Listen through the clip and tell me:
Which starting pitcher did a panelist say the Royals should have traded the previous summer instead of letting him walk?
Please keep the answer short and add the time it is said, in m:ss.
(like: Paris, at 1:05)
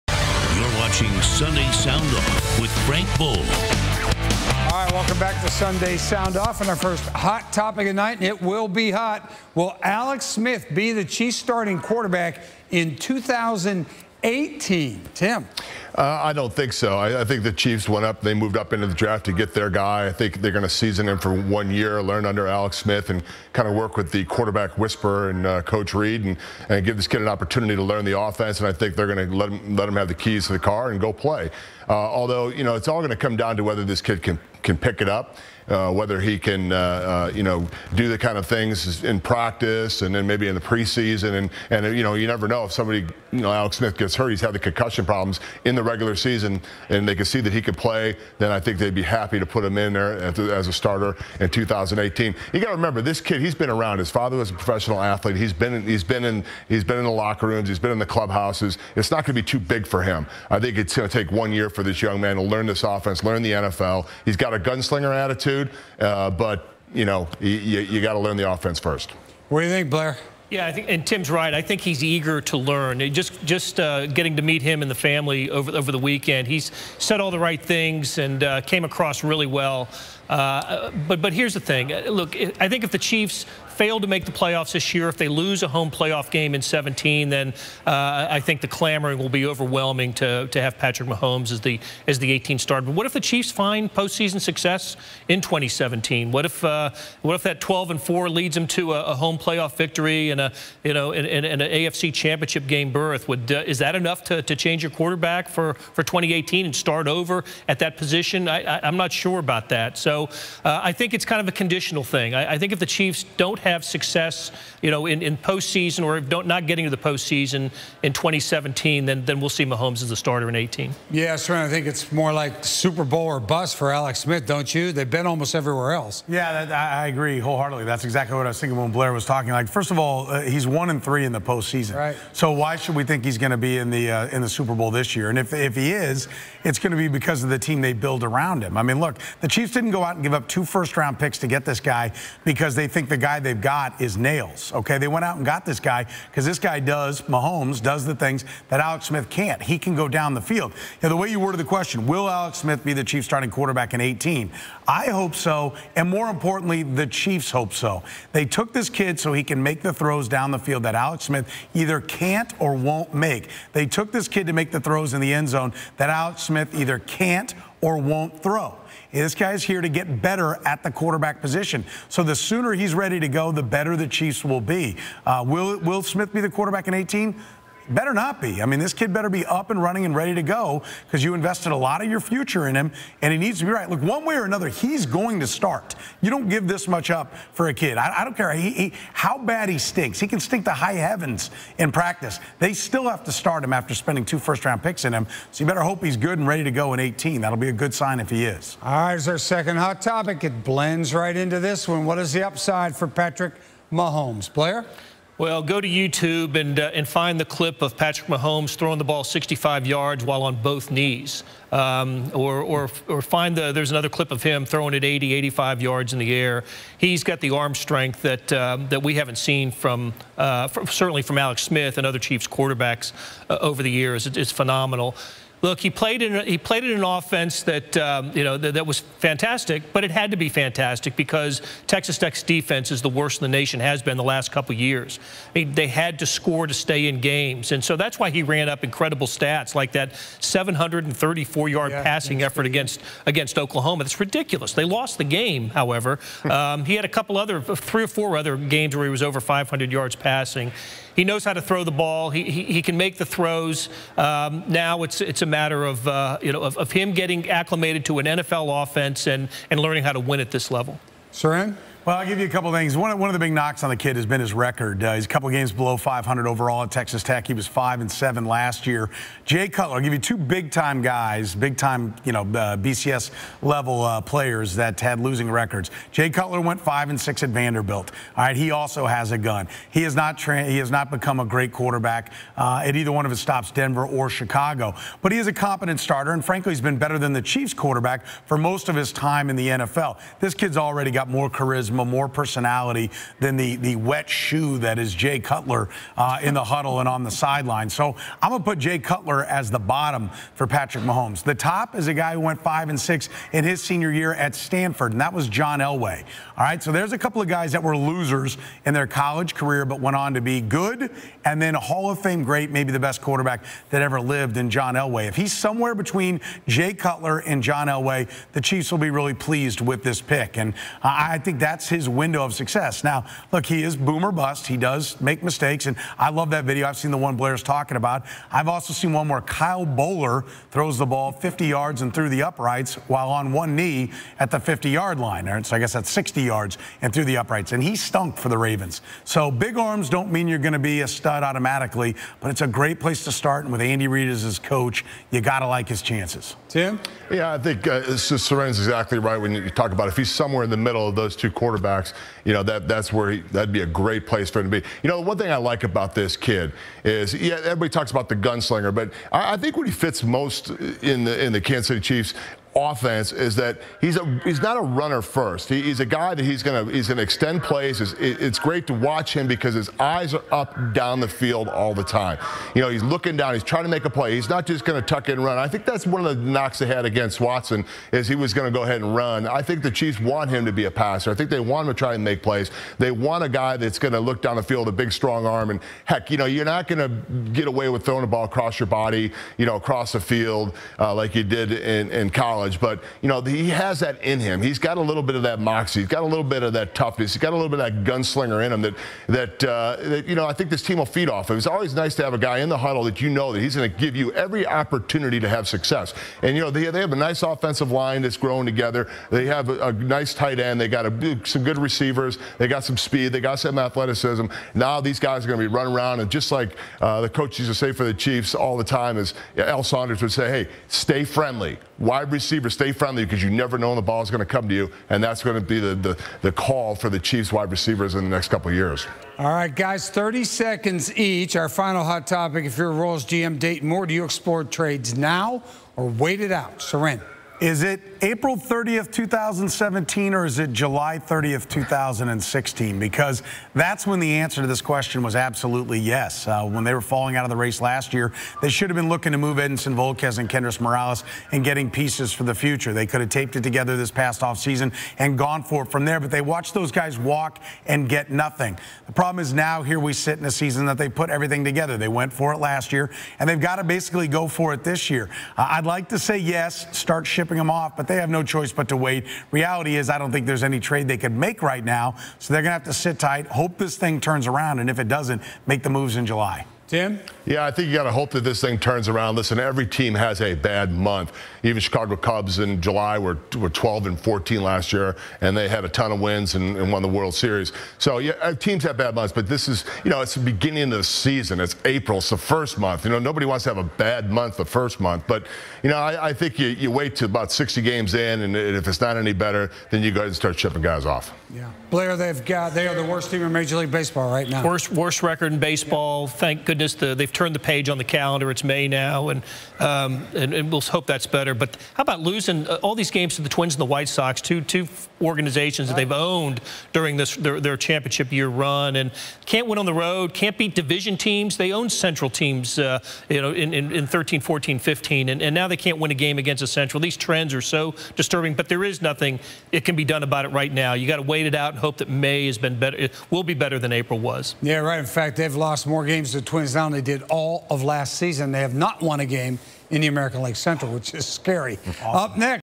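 Edinson Volquez, at 7:29.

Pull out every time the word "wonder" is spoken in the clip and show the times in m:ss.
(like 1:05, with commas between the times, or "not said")
not said.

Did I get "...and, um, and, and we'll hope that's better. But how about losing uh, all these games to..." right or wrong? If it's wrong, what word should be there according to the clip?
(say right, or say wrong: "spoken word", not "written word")
right.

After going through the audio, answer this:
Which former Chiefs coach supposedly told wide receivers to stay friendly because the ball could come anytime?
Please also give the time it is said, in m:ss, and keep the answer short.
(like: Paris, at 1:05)
Al Saunders, at 6:59.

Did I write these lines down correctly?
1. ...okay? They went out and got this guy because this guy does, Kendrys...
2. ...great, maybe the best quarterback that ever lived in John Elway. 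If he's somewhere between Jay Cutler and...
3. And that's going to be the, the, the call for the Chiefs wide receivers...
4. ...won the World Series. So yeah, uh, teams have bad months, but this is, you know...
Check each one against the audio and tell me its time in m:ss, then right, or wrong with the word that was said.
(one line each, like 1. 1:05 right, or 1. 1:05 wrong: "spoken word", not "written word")
1. 2:24 wrong: "Mahomes", not "Kendrys"
2. 5:12 right
3. 7:05 right
4. 8:06 right.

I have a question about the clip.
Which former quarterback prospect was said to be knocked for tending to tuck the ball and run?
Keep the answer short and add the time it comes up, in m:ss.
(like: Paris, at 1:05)
Watson, at 6:17.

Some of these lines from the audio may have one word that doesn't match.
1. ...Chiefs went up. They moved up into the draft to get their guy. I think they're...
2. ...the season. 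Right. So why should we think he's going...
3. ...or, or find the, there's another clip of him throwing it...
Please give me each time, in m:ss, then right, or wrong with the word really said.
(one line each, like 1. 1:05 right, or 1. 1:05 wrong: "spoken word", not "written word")
1. 0:17 right
2. 2:11 wrong: "postseason", not "season"
3. 3:32 right.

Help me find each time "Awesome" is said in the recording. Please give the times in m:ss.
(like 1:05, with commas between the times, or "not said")
9:01.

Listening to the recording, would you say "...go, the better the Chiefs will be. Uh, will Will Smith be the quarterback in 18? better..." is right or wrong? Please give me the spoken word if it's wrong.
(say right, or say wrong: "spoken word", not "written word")
right.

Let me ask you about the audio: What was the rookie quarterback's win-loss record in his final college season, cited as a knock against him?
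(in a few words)
5 and 7.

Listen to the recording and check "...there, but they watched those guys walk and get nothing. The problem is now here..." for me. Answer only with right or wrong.
right.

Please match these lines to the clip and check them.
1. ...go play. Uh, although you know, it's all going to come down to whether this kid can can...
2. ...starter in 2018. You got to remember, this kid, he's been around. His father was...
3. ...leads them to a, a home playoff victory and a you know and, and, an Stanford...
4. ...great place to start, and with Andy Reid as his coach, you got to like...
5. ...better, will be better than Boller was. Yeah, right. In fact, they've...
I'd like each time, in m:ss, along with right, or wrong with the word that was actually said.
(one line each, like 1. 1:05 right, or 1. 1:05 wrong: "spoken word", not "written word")
1. 0:31 right
2. 0:50 right
3. 1:38 wrong: "AFC", not "Stanford"
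4. 5:42 right
5. 8:52 wrong: "April", not "Boller".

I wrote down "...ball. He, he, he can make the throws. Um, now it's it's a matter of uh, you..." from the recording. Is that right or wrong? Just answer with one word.
right.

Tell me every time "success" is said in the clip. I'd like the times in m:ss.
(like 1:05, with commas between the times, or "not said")
1:34, 1:53, 5:22, 6:45.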